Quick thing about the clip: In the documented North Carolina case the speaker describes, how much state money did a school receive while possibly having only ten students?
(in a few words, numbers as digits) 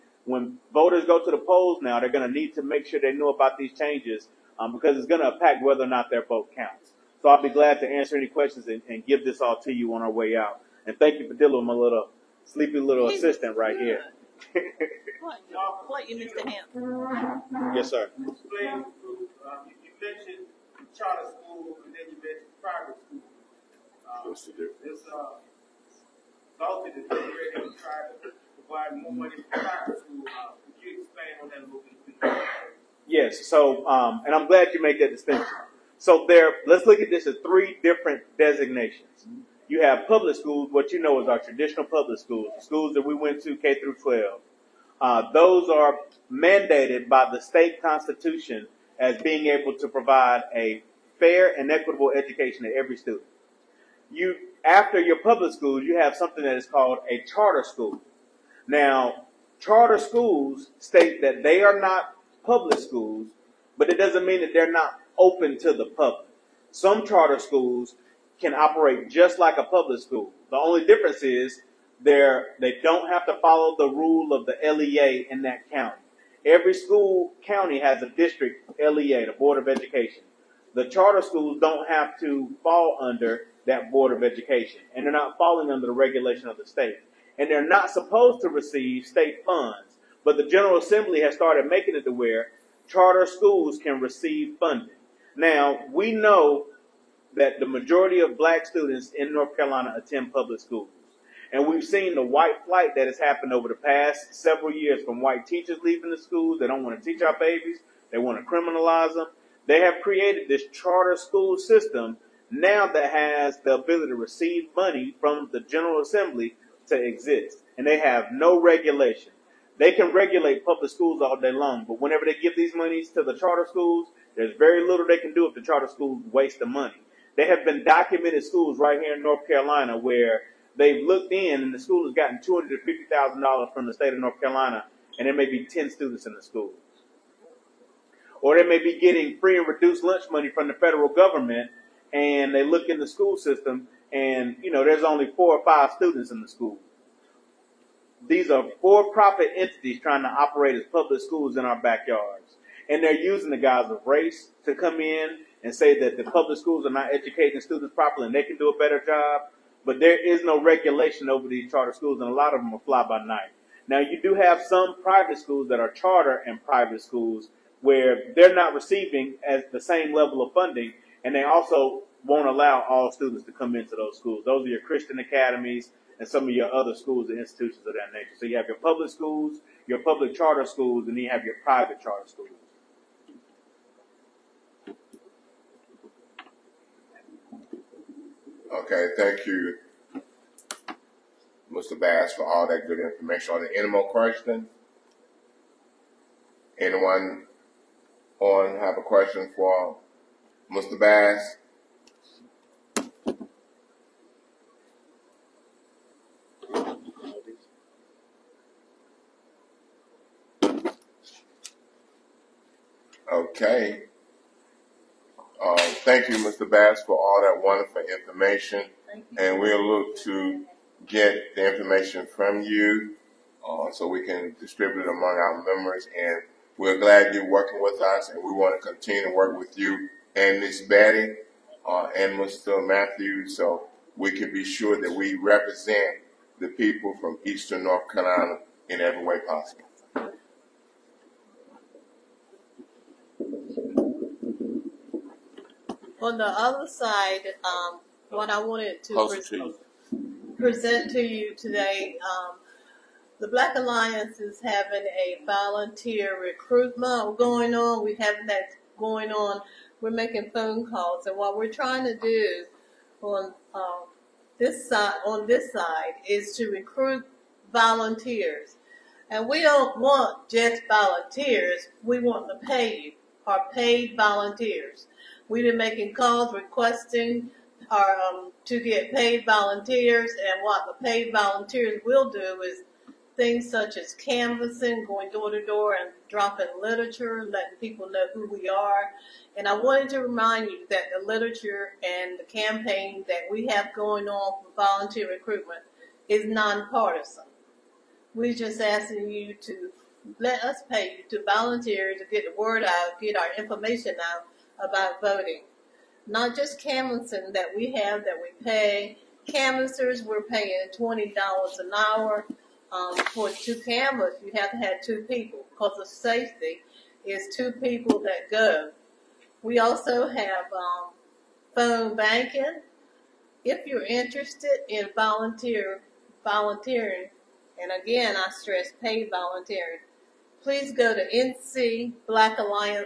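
$250,000.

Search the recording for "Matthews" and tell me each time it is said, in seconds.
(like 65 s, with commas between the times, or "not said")
232 s.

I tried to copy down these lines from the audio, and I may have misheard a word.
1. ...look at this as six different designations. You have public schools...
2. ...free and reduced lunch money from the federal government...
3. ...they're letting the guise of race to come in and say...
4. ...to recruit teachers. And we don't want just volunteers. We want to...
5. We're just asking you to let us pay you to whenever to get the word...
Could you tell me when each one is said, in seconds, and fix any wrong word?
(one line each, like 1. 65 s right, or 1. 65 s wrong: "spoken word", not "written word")
1. 36 s wrong: "three", not "six"
2. 139 s right
3. 153 s wrong: "using", not "letting"
4. 266 s wrong: "volunteers", not "teachers"
5. 298 s wrong: "volunteer", not "whenever".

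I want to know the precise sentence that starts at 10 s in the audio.
And thank you for dealing with my little sleepy little assistant right here.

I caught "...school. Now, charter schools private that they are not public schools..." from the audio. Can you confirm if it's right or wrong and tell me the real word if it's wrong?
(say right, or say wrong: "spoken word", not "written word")
wrong: "state", not "private".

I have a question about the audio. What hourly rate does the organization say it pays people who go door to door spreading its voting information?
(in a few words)
$20 an hour.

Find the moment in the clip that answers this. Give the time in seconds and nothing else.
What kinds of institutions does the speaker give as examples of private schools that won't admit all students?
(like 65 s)
174 s.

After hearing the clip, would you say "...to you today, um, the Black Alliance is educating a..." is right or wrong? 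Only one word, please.
wrong.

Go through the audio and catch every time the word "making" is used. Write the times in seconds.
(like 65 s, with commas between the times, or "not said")
91 s, 260 s, 275 s.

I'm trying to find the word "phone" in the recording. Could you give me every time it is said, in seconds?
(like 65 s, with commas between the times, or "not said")
260 s, 321 s.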